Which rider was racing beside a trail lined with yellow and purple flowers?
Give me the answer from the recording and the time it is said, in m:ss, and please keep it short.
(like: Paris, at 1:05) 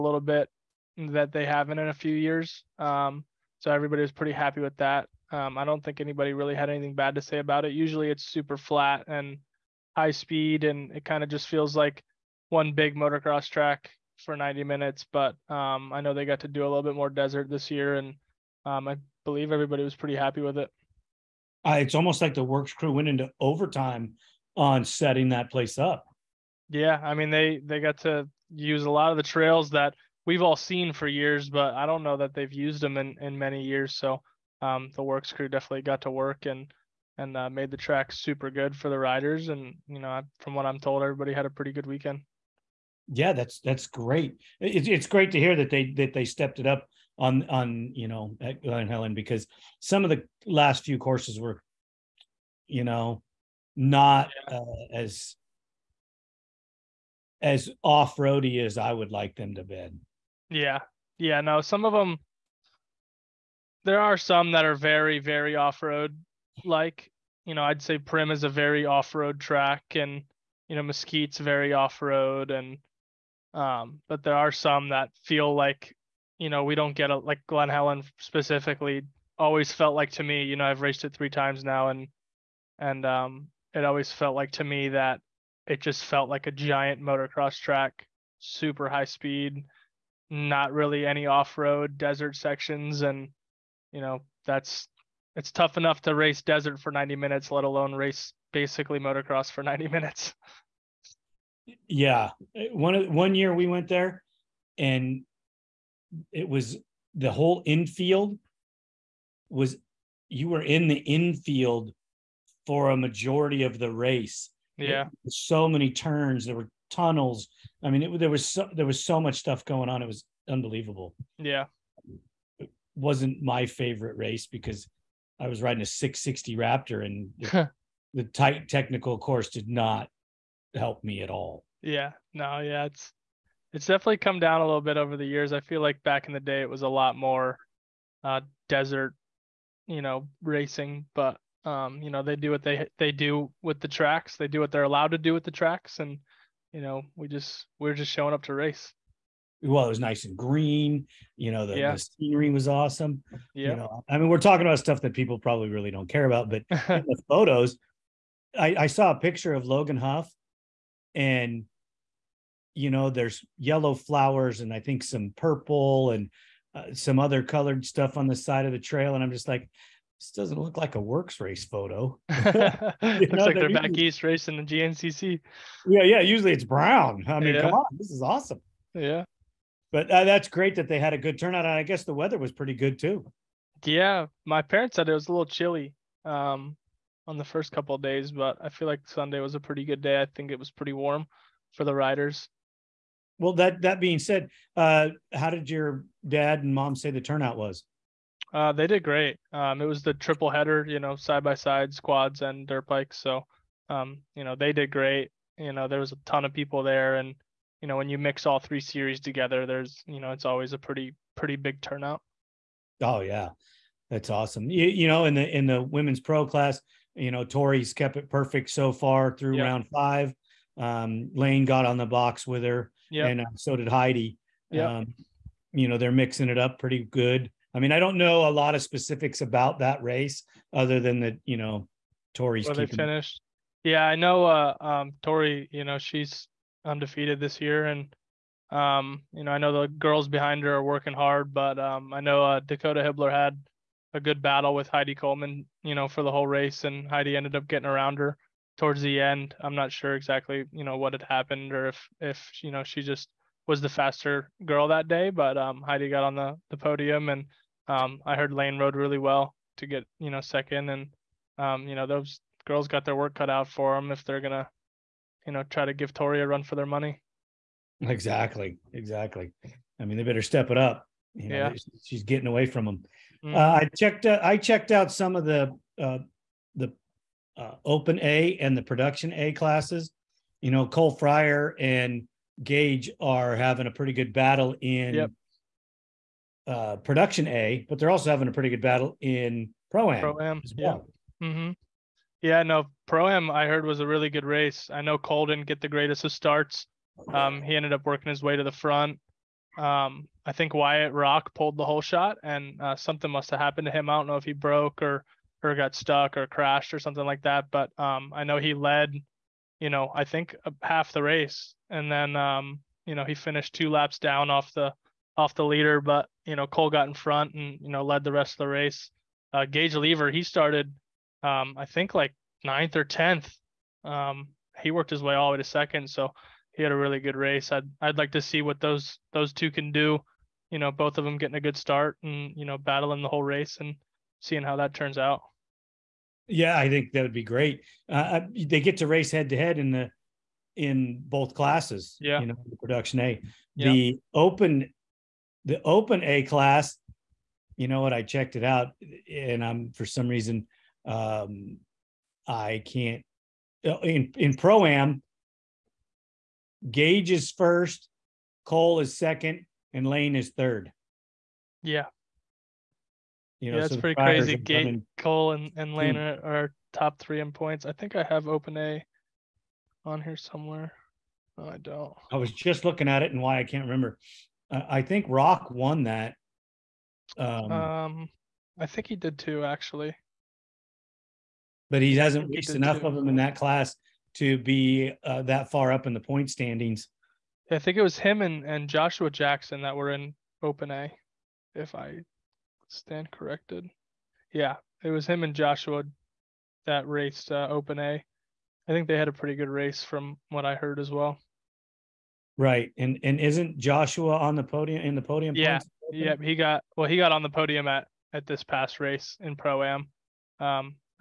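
Logan Huff, at 2:39.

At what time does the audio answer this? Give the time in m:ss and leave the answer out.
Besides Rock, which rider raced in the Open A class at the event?
6:28.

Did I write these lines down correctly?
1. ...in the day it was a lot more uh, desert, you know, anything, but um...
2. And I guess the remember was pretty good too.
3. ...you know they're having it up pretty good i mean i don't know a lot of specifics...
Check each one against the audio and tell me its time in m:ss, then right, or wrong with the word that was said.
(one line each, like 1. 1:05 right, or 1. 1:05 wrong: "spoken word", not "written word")
1. 2:16 wrong: "racing", not "anything"
2. 3:01 wrong: "weather", not "remember"
3. 3:45 wrong: "mixing", not "having".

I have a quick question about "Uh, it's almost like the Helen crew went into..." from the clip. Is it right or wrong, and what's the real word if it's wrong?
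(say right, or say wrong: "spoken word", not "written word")
wrong: "WORCS", not "Helen".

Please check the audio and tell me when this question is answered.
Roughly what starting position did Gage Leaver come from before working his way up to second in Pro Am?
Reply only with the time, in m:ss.
5:22.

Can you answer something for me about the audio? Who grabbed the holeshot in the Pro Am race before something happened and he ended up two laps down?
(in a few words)
Wyatt Rock.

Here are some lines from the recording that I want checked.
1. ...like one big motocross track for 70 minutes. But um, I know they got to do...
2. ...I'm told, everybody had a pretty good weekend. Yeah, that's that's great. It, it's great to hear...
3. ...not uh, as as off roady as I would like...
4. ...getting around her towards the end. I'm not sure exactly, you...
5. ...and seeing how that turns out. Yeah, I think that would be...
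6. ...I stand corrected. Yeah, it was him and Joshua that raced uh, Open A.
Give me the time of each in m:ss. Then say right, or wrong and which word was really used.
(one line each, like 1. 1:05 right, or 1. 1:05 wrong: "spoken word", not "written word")
1. 0:11 wrong: "90", not "70"
2. 0:40 right
3. 0:53 right
4. 4:07 right
5. 5:33 right
6. 6:31 right.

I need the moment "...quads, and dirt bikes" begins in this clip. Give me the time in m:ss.
3:21.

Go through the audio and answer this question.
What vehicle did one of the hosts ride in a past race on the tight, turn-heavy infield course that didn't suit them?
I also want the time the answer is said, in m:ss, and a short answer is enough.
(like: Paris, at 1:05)
660 Raptor, at 2:05.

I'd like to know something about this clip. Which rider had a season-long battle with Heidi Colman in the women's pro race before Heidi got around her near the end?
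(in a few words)
Dakota Hibbler.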